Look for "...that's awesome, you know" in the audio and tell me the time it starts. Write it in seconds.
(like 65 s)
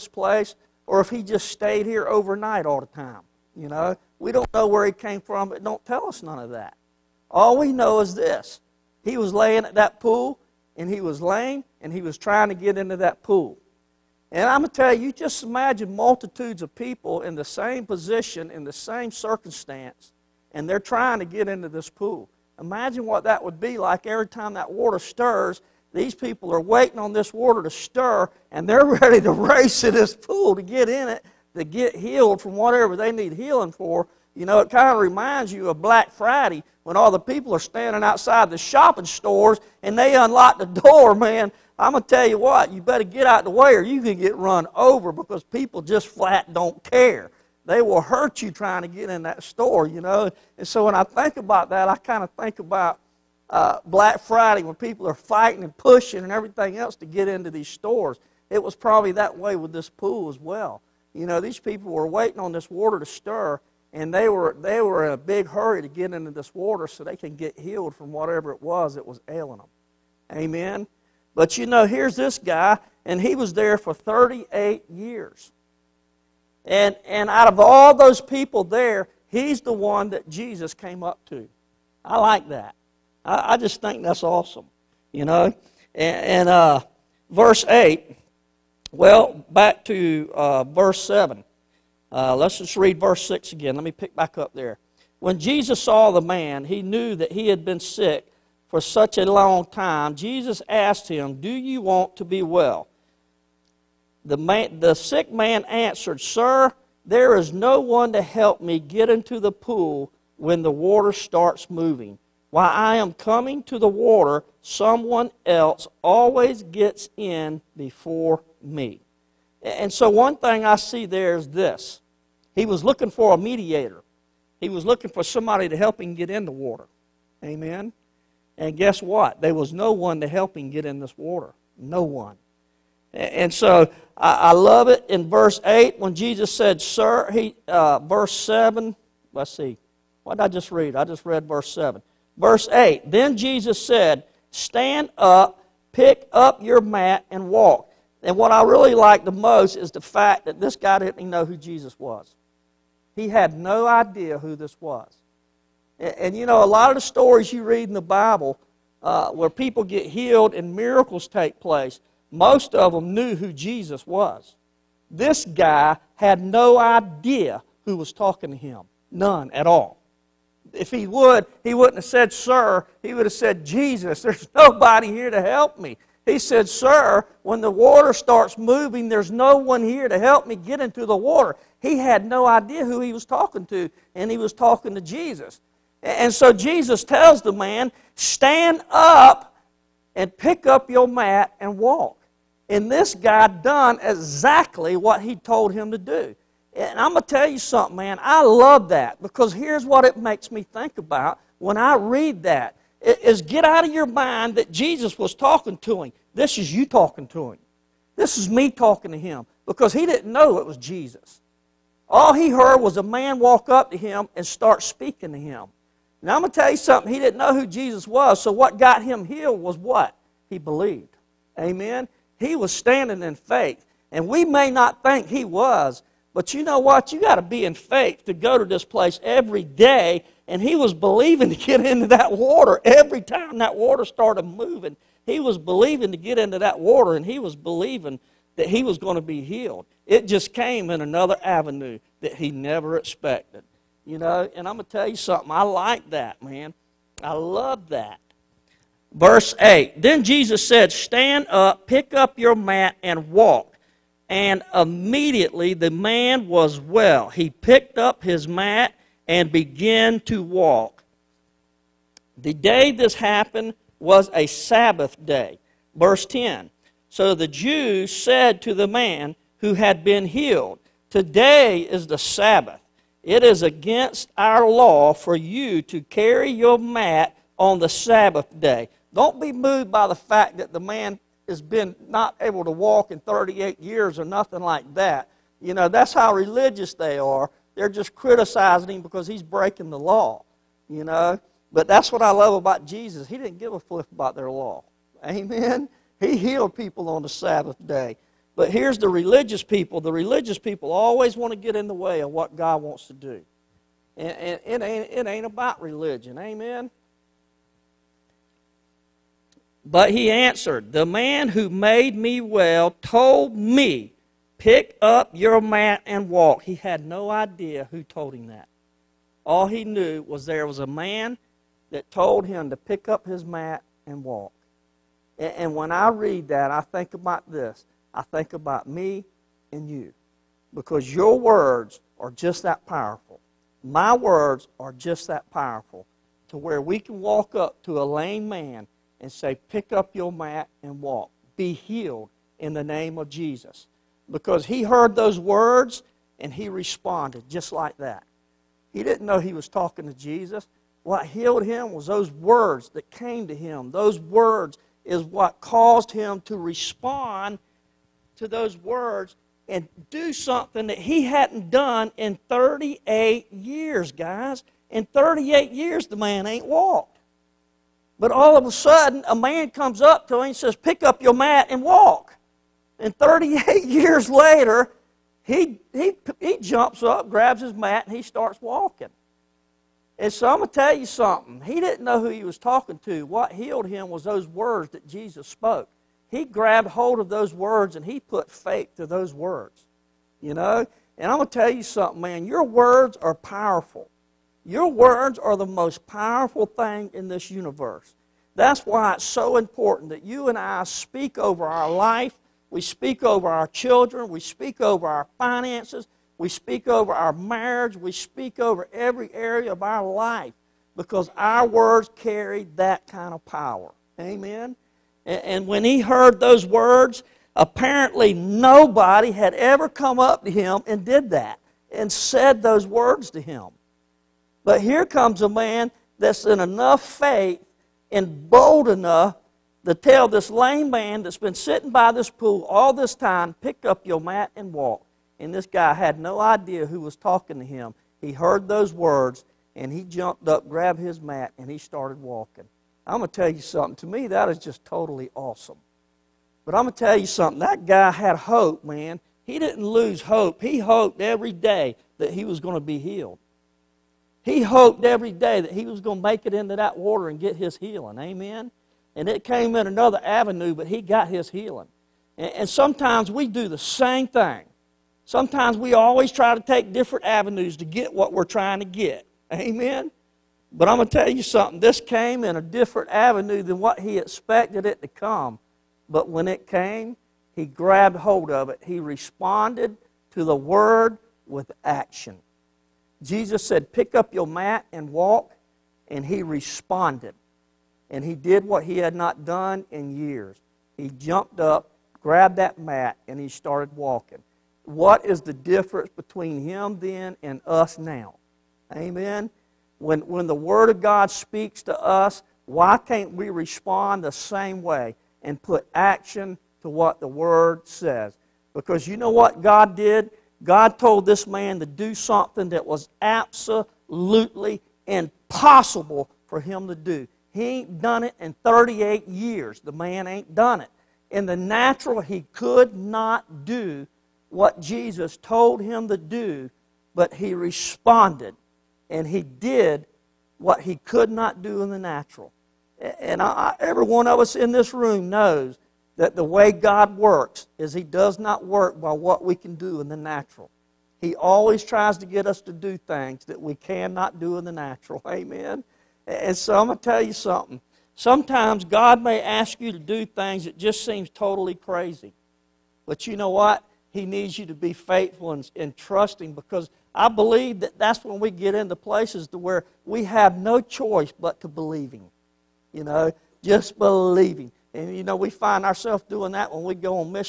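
84 s.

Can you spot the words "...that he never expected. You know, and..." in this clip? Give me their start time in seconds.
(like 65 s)
242 s.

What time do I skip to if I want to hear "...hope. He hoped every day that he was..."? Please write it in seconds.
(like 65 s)
450 s.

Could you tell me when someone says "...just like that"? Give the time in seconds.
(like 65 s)
347 s.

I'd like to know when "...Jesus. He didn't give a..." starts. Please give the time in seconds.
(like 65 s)
292 s.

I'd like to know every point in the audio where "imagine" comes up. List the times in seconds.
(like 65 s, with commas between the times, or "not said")
15 s, 22 s.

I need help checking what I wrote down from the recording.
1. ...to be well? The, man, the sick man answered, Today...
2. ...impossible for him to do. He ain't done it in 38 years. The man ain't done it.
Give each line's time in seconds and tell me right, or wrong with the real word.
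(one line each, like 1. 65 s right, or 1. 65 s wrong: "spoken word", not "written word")
1. 102 s wrong: "Sir", not "Today"
2. 515 s right.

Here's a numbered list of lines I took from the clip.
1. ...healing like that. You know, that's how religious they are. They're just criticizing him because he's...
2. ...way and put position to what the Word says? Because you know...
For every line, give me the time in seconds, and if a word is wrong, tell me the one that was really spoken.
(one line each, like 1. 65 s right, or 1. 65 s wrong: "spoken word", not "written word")
1. 284 s wrong: "nothing", not "healing"
2. 504 s wrong: "action", not "position".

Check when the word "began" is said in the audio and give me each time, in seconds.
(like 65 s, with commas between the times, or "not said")
259 s.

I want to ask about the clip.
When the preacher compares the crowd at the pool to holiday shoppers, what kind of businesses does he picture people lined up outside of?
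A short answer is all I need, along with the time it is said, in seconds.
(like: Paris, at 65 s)
shopping stores, at 38 s.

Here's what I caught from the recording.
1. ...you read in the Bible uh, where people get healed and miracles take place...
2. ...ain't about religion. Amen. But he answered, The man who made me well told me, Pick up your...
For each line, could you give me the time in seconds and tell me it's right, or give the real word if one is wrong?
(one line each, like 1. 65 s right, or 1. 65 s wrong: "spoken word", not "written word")
1. 157 s right
2. 305 s right.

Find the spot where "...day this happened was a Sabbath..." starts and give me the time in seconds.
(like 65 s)
262 s.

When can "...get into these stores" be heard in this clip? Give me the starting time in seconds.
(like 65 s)
57 s.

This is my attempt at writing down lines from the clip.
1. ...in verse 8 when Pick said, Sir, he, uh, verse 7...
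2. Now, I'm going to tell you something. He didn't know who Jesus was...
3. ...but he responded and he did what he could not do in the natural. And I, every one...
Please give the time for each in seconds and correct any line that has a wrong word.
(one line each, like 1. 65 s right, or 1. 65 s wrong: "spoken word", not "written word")
1. 135 s wrong: "Jesus", not "Pick"
2. 216 s right
3. 527 s right.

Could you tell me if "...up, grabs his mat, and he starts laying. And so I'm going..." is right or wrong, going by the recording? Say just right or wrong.
wrong.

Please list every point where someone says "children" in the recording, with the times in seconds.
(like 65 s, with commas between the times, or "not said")
403 s.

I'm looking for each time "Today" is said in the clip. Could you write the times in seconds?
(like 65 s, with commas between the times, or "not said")
271 s.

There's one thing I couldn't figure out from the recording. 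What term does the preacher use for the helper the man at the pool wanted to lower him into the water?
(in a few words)
mediator.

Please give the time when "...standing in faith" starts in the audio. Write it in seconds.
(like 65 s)
222 s.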